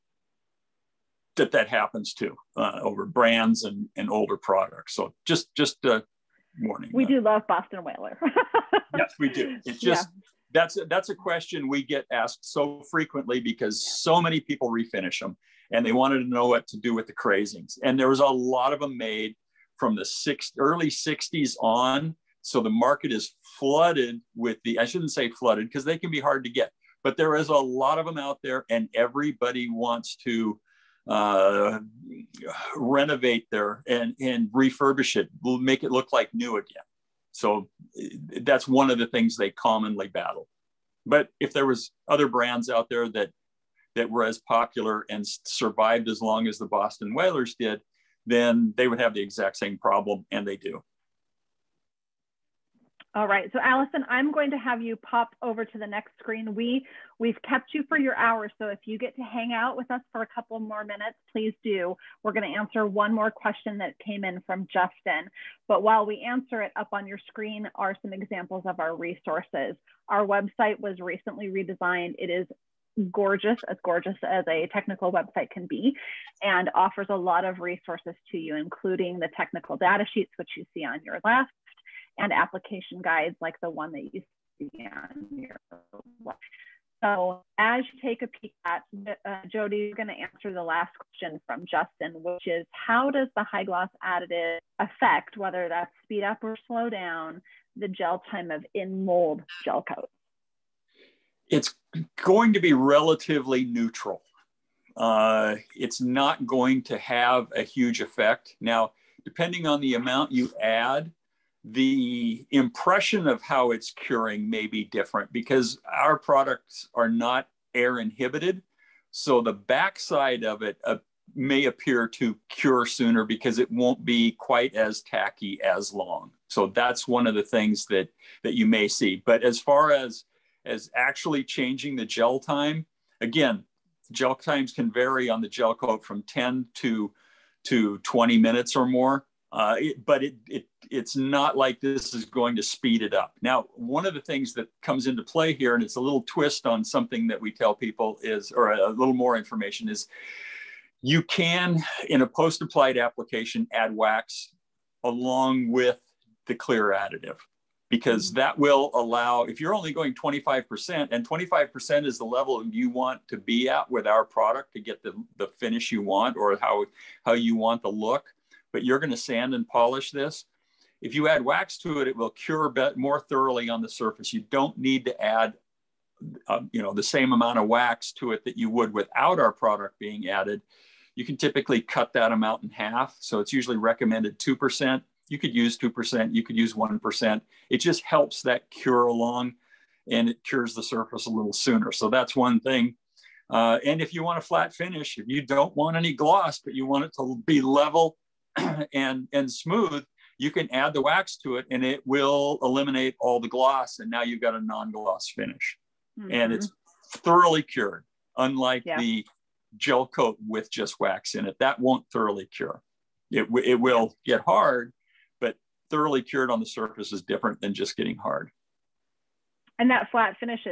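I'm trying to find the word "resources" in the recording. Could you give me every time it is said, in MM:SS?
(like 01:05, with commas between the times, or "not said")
01:08, 01:17.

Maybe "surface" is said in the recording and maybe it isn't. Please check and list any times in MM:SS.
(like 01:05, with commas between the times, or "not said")
02:53, 03:10, 03:36.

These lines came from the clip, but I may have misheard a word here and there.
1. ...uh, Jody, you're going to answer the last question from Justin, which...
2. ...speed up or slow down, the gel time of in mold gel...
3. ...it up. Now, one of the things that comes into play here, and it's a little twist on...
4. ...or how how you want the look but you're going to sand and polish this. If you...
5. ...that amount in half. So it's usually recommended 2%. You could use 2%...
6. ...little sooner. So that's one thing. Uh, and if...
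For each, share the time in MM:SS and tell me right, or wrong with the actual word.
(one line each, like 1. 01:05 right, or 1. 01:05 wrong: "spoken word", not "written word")
1. 01:29 right
2. 01:36 right
3. 02:23 right
4. 02:46 right
5. 03:02 right
6. 03:11 right.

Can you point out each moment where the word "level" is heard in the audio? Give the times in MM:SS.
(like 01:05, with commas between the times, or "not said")
02:42, 03:17.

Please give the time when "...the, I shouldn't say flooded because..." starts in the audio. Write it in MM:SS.
00:24.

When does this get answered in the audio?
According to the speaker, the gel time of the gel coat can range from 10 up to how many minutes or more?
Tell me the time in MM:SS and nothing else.
02:17.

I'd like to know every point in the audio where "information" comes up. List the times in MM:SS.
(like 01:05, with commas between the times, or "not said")
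02:29.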